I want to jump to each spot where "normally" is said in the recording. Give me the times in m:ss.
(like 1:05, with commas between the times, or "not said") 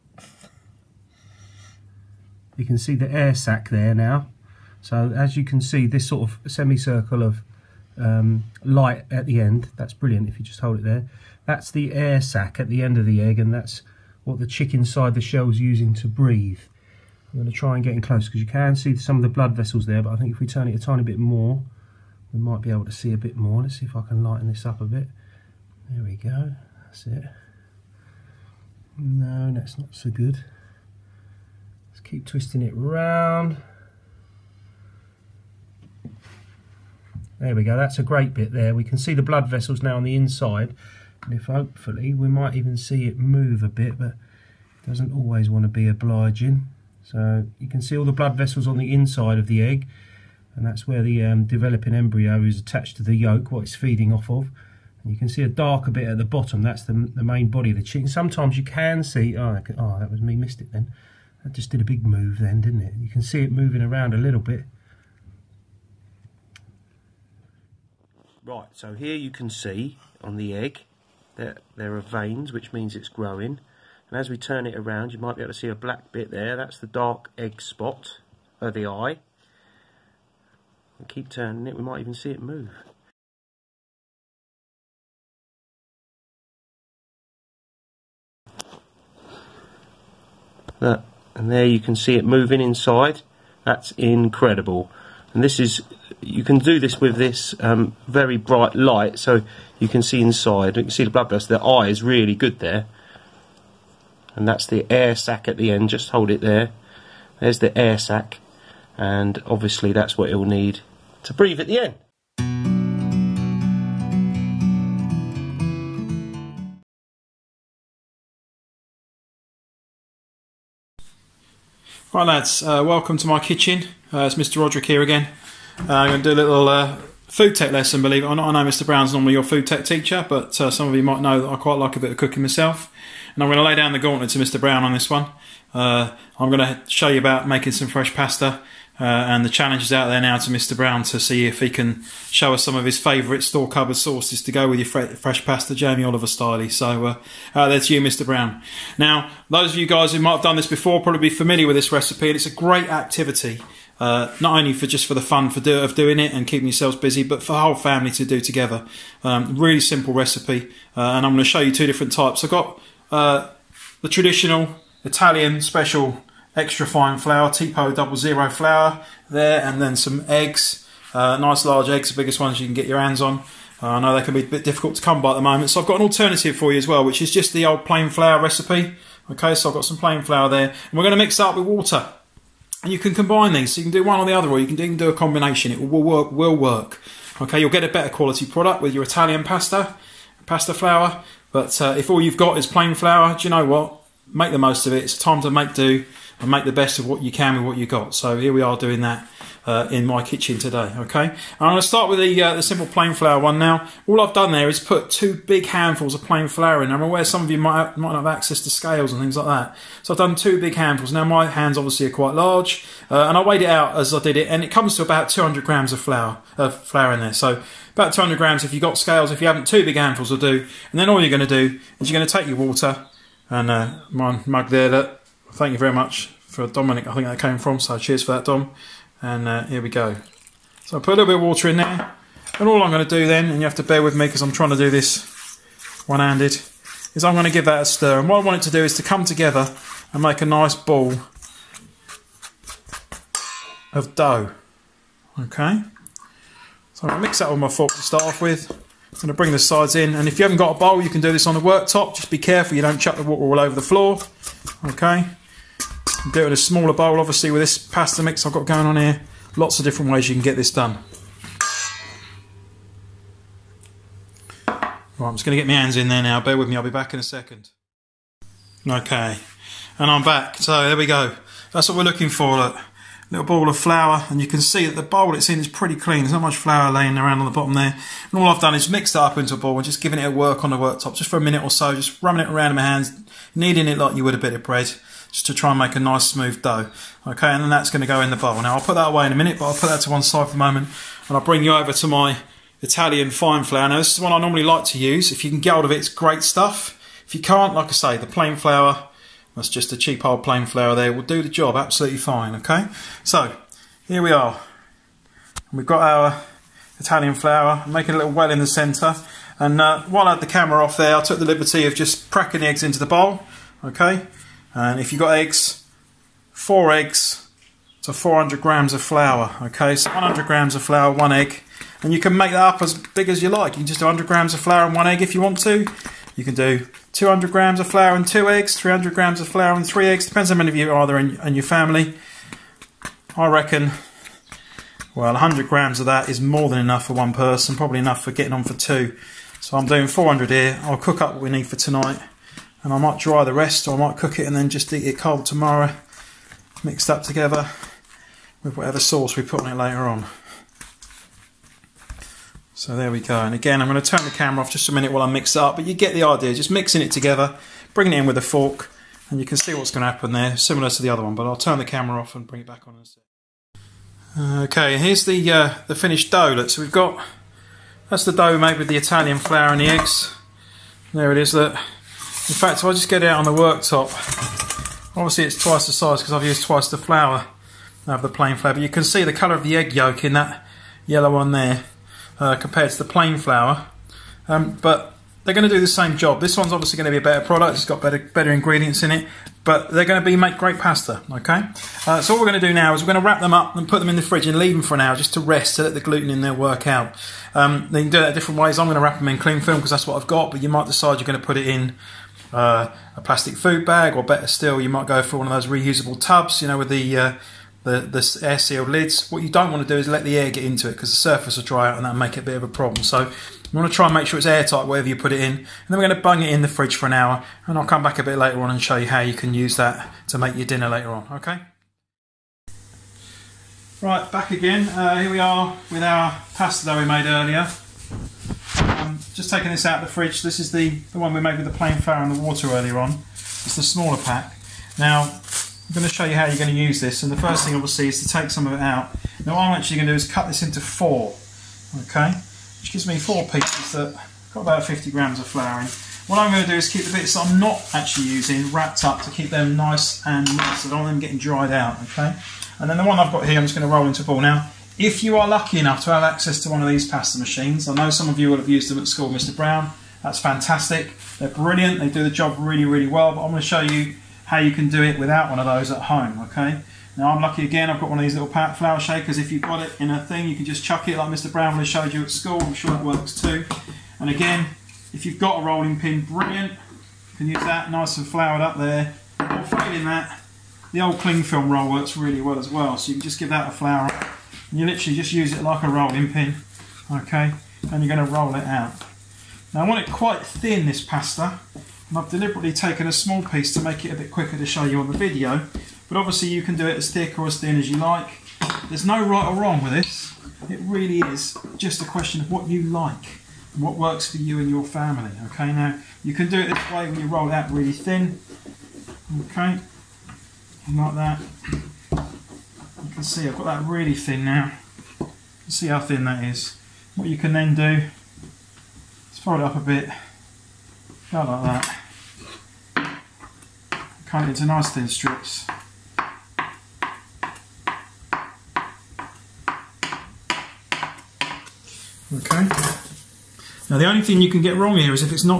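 2:09, 4:54.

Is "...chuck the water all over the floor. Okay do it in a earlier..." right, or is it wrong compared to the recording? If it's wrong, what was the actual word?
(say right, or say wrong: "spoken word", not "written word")
wrong: "smaller", not "earlier".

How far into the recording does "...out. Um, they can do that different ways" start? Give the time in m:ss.
6:36.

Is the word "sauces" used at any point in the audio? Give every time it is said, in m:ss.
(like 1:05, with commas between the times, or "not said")
2:23, 5:49.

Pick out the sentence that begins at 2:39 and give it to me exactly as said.
Um, really simple recipe, uh, and I'm going to show you two different types.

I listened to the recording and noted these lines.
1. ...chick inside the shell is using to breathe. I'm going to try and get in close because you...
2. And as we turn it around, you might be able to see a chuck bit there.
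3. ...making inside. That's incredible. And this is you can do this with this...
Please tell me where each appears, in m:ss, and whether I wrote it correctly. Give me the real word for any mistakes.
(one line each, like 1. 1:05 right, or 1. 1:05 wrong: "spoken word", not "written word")
1. 0:14 right
2. 1:14 wrong: "black", not "chuck"
3. 1:32 wrong: "moving", not "making".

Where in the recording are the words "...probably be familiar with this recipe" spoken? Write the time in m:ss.
2:31.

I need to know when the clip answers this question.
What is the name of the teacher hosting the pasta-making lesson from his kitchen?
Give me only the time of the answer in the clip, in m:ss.
2:04.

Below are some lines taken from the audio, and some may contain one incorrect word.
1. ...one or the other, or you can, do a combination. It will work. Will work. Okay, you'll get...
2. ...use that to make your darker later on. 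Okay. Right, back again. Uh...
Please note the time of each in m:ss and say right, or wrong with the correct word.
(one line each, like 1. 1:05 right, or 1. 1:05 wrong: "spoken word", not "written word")
1. 3:04 right
2. 6:59 wrong: "dinner", not "darker".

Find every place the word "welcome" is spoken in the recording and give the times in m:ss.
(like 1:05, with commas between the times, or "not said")
2:02.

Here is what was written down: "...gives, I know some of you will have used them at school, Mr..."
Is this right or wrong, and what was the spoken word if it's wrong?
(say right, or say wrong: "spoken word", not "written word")
wrong: "machines", not "gives".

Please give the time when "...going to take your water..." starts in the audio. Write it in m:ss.
3:42.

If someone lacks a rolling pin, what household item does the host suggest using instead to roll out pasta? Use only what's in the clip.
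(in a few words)
cling film roll.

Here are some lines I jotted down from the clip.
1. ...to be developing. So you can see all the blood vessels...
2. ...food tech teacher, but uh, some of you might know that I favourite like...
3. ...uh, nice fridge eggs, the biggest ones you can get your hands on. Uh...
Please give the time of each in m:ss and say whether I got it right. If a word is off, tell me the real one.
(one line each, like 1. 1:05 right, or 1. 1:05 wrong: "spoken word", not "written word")
1. 0:45 wrong: "obliging", not "developing"
2. 2:09 wrong: "quite", not "favourite"
3. 2:51 wrong: "large", not "fridge".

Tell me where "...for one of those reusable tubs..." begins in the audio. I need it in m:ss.
6:45.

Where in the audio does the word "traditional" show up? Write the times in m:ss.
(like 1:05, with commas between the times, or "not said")
2:44.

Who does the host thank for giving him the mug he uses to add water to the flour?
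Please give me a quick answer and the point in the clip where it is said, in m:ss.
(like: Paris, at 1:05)
Dominic, at 3:46.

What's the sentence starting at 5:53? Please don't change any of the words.
And again, I'm going to turn the camera off just a minute while I mix it up, but you get the idea.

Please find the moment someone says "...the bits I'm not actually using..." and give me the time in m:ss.
7:27.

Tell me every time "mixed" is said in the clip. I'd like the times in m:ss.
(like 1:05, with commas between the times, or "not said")
4:38, 5:46.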